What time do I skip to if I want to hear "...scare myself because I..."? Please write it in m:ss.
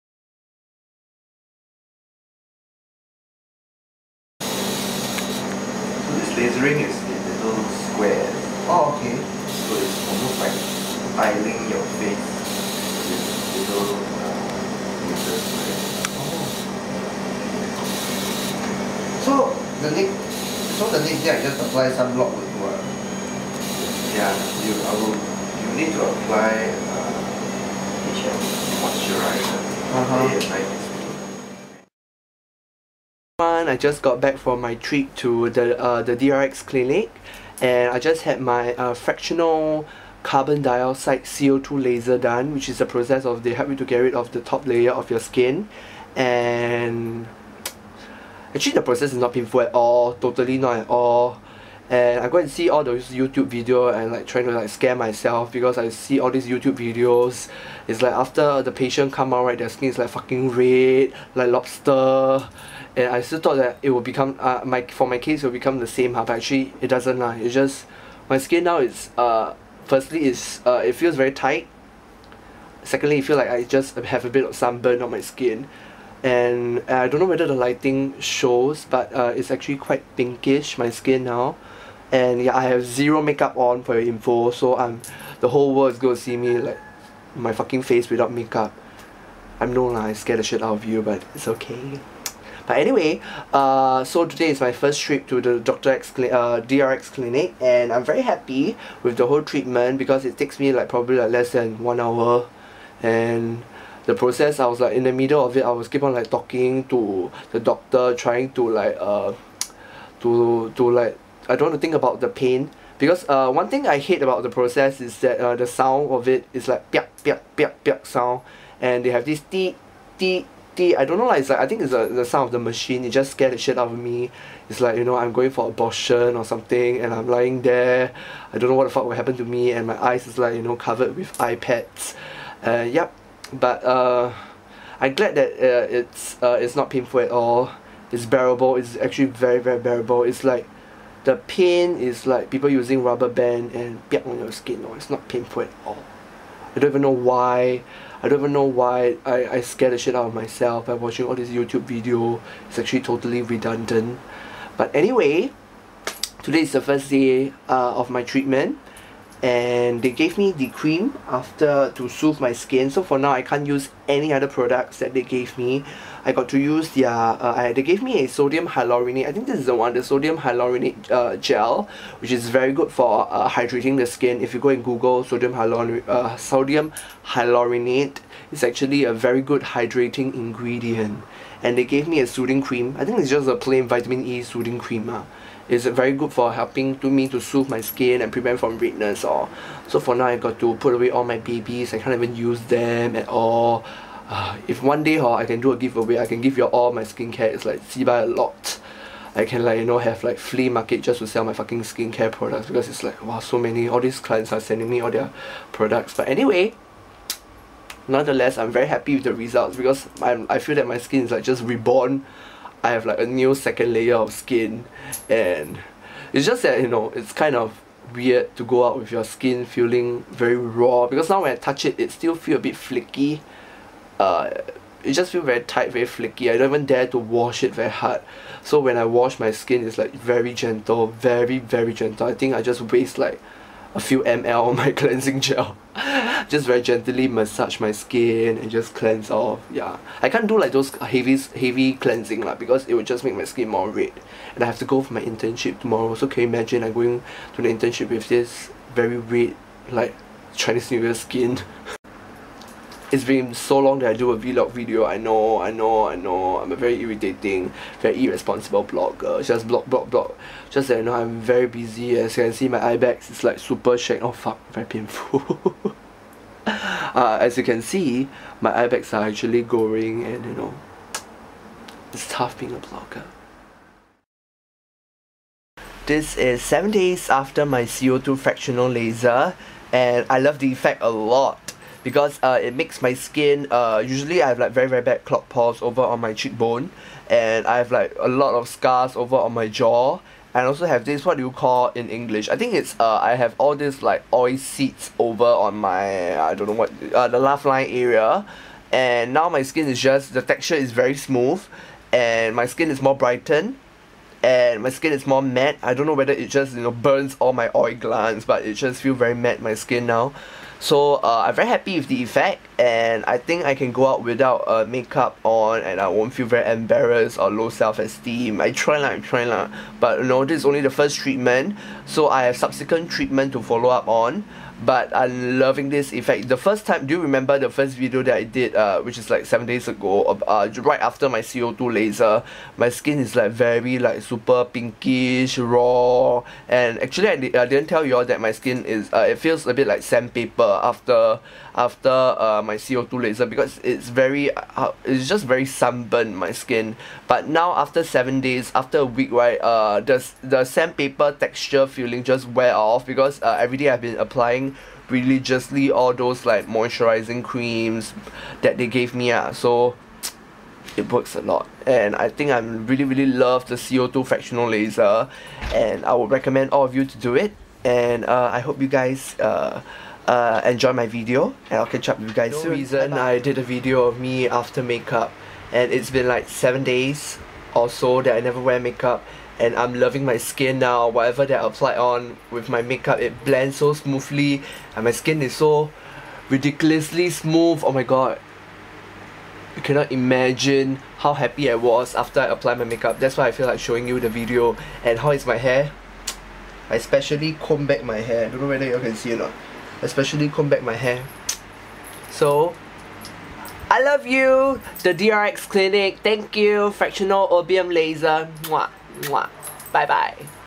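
0:54.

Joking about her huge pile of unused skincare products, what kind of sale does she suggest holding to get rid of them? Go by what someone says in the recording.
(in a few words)
Flea market.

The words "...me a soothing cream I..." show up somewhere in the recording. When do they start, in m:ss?
3:02.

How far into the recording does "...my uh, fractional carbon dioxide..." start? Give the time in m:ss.
0:38.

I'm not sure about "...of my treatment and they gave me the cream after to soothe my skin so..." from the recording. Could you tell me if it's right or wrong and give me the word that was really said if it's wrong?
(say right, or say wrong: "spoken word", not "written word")
right.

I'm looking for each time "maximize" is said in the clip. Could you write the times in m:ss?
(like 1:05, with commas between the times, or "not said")
not said.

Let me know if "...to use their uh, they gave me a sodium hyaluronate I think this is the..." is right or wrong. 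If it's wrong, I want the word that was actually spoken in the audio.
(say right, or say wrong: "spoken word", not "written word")
right.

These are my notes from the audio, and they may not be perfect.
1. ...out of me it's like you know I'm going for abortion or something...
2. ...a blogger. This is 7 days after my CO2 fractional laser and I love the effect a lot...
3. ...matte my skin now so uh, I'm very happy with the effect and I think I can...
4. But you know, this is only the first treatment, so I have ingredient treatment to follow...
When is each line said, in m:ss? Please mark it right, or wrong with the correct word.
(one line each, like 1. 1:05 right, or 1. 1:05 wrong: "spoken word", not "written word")
1. 2:03 right
2. 4:32 right
3. 5:09 right
4. 5:19 wrong: "subsequent", not "ingredient".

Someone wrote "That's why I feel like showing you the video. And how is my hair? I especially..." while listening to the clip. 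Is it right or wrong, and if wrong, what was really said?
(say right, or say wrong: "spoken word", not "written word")
right.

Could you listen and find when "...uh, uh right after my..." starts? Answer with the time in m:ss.
5:30.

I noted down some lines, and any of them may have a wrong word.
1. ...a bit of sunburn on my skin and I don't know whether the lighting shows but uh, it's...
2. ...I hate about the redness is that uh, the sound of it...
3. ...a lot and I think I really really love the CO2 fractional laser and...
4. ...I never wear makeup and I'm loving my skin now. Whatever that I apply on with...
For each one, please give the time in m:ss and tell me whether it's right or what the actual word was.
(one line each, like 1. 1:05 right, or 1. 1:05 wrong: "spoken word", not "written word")
1. 1:14 right
2. 1:53 wrong: "process", not "redness"
3. 6:01 right
4. 6:18 right.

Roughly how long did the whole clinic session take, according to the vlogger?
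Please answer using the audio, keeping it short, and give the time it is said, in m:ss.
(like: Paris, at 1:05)
Less than one hour, at 1:41.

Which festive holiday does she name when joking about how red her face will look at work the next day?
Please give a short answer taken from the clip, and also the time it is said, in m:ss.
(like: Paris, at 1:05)
Chinese New Year, at 4:10.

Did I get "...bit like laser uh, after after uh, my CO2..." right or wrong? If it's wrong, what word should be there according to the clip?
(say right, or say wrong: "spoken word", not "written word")
wrong: "sandpaper", not "laser".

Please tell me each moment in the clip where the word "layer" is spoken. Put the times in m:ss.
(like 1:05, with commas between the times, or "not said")
0:44, 3:33.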